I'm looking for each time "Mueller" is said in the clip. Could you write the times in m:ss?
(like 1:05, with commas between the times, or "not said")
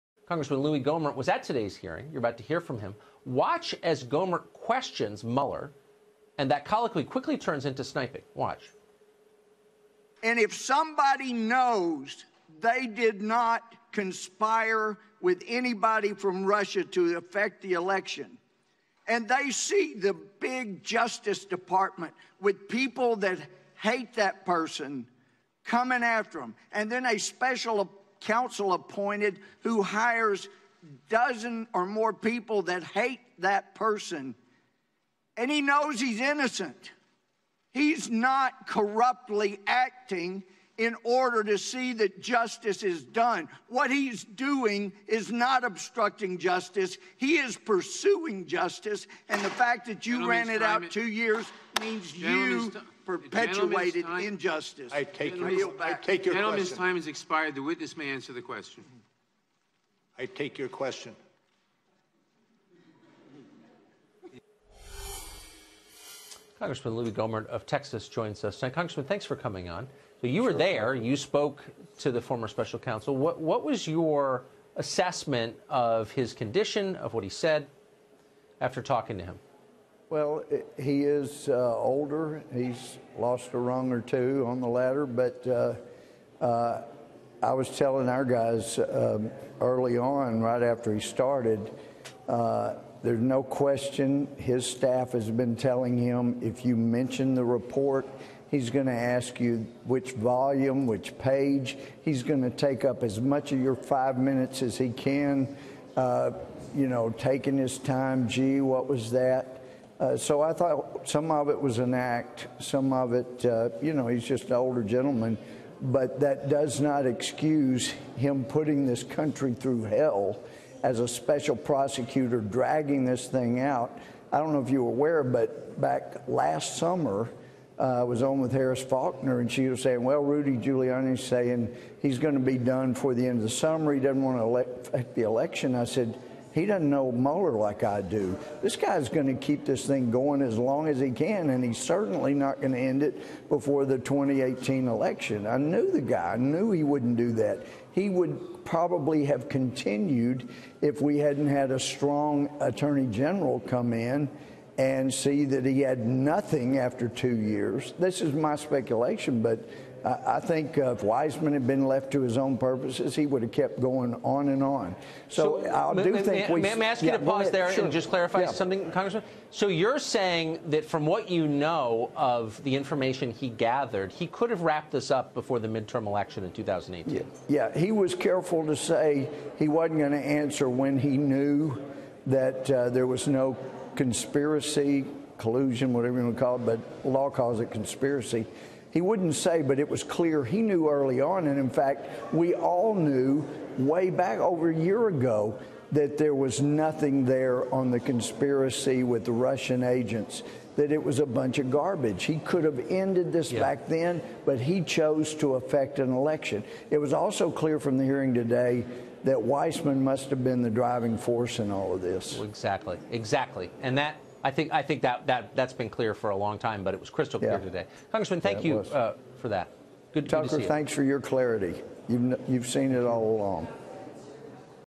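0:05, 2:17.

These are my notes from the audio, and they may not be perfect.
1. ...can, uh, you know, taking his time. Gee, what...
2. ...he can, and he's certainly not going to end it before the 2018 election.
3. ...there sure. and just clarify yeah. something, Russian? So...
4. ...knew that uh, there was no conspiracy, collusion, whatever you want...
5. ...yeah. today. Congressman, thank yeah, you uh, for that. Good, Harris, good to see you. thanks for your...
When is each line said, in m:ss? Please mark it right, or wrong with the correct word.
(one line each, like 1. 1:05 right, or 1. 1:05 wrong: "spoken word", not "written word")
1. 1:44 right
2. 2:20 right
3. 2:47 wrong: "Congressman", not "Russian"
4. 3:01 right
5. 3:37 wrong: "Tucker", not "Harris".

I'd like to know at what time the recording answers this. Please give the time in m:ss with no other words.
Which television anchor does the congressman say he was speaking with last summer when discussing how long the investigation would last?
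2:08.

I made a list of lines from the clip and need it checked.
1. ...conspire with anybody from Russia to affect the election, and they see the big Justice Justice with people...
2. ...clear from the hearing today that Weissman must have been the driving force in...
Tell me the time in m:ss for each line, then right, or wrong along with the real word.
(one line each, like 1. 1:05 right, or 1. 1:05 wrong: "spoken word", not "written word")
1. 0:13 wrong: "Department", not "Justice"
2. 3:27 right.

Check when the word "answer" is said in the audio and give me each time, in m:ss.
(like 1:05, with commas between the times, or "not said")
0:58, 3:00.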